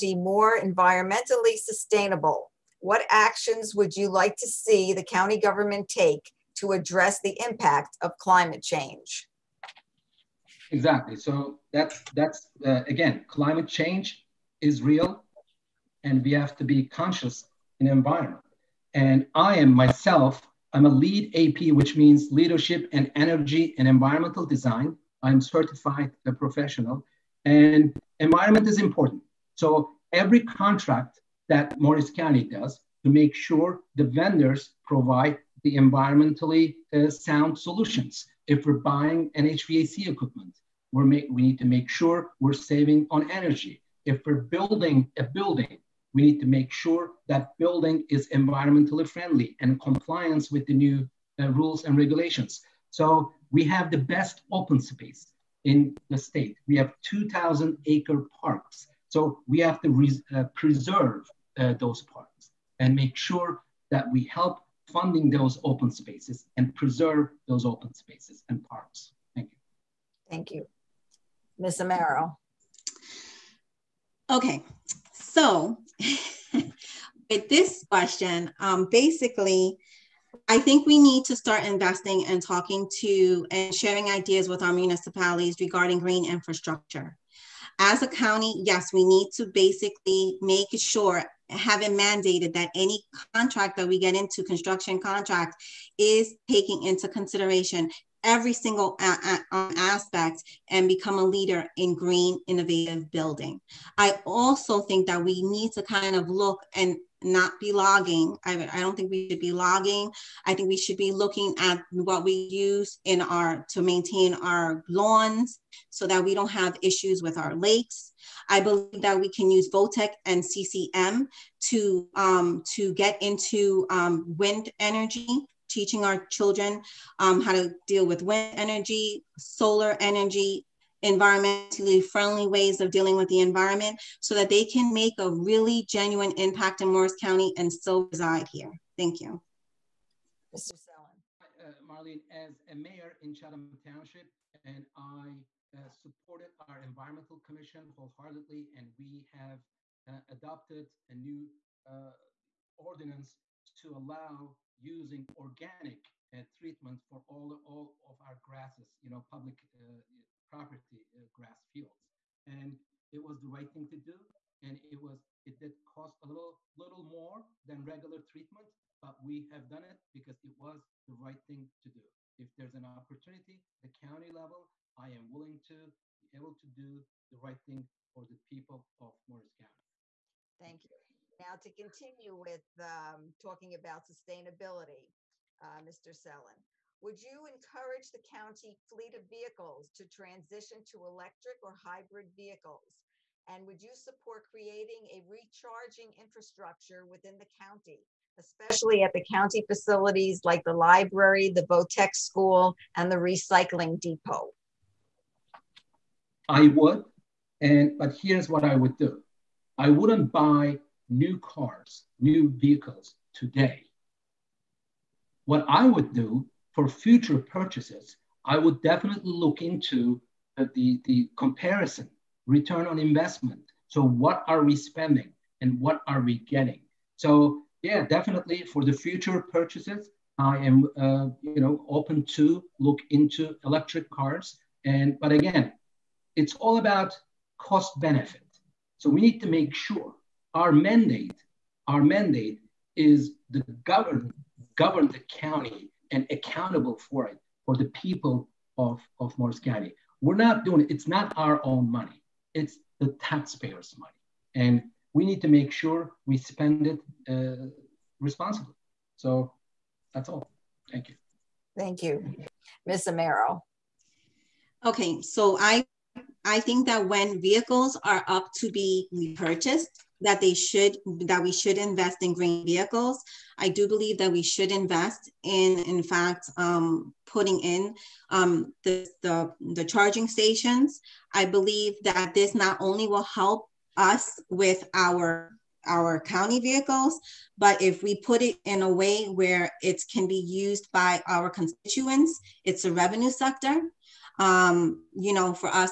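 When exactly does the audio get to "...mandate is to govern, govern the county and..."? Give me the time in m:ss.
4:02.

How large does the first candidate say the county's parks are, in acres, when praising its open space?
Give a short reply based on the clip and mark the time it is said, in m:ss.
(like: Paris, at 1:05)
2,000 acre, at 0:57.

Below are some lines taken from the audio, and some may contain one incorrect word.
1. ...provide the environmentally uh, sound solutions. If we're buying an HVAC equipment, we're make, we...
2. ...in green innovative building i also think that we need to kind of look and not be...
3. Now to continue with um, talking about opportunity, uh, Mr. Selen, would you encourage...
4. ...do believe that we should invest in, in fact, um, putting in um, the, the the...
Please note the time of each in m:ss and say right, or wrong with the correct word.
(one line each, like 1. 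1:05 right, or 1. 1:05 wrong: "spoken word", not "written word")
1. 0:34 right
2. 1:41 right
3. 3:01 wrong: "sustainability", not "opportunity"
4. 4:33 right.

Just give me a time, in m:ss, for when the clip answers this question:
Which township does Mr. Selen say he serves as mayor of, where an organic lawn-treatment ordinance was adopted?
2:23.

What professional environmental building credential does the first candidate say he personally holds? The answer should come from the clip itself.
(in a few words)
LEED AP.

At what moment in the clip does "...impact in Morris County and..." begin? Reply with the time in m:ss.
2:16.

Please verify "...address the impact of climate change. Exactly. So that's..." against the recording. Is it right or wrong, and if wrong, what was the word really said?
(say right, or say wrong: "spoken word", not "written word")
right.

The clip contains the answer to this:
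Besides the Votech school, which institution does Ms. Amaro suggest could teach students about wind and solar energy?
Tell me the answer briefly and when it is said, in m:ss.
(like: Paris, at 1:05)
CCM, at 2:00.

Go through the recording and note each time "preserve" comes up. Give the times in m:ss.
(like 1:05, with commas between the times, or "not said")
1:00, 1:06.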